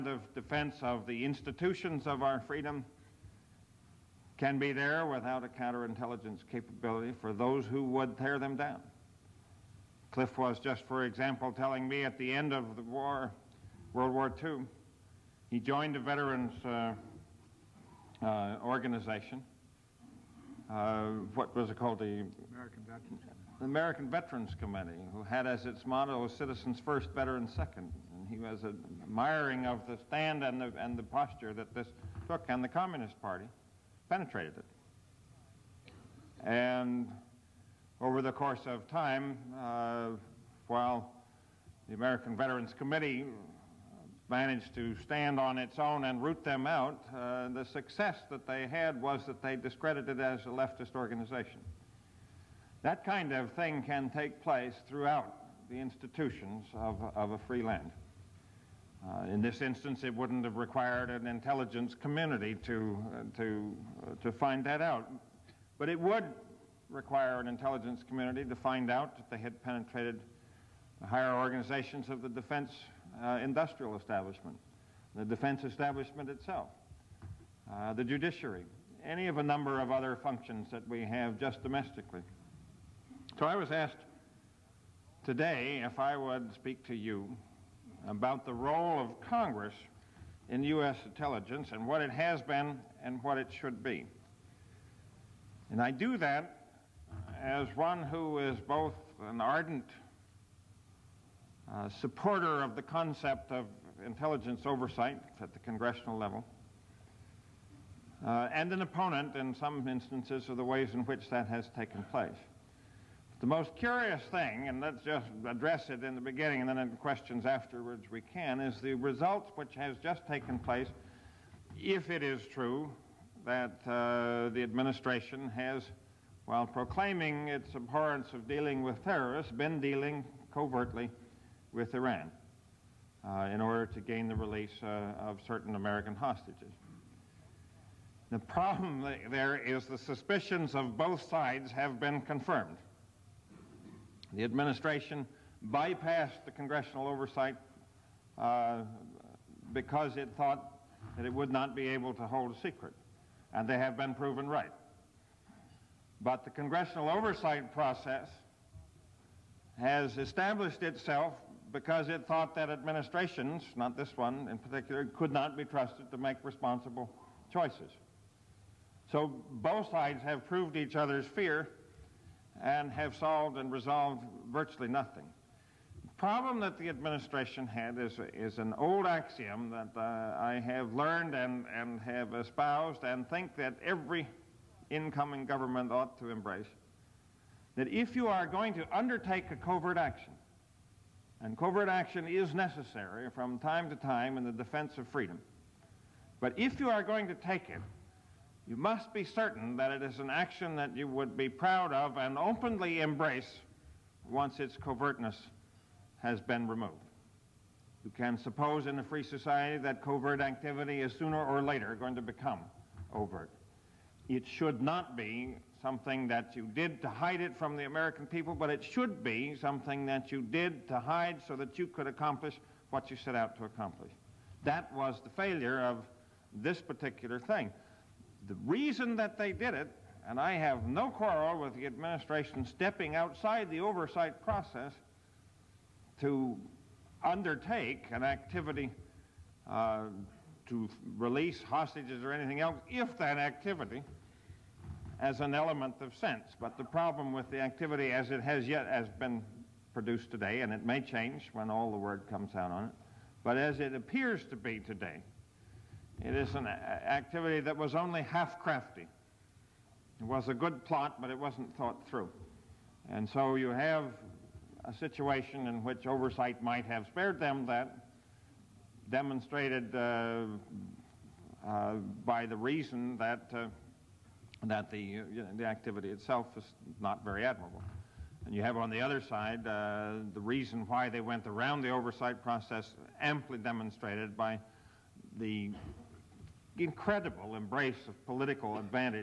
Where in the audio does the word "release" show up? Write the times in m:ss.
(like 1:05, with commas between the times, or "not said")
2:14, 4:01.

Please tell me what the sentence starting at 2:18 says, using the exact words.
The problem there is the suspicions of both sides have been confirmed.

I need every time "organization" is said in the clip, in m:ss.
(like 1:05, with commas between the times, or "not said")
0:18, 0:50, 1:11.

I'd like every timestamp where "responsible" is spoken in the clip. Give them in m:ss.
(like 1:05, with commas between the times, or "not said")
2:46.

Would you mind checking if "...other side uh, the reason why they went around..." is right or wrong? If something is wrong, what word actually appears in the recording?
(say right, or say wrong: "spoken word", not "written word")
right.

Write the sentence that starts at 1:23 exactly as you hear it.
So I was asked today if I would speak to you about the role of Congress in U.S.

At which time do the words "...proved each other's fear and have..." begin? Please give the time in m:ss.
2:50.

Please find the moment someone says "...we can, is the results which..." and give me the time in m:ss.
1:58.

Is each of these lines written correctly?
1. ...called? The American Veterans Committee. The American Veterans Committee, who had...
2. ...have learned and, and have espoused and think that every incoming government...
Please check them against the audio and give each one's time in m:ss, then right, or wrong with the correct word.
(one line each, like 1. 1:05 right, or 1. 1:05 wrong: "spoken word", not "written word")
1. 0:21 right
2. 3:00 right.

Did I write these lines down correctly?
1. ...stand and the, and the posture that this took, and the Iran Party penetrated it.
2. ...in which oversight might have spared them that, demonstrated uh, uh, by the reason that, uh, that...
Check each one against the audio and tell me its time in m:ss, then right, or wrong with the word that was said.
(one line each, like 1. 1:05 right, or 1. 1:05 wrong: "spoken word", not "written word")
1. 0:30 wrong: "Communist", not "Iran"
2. 4:25 right.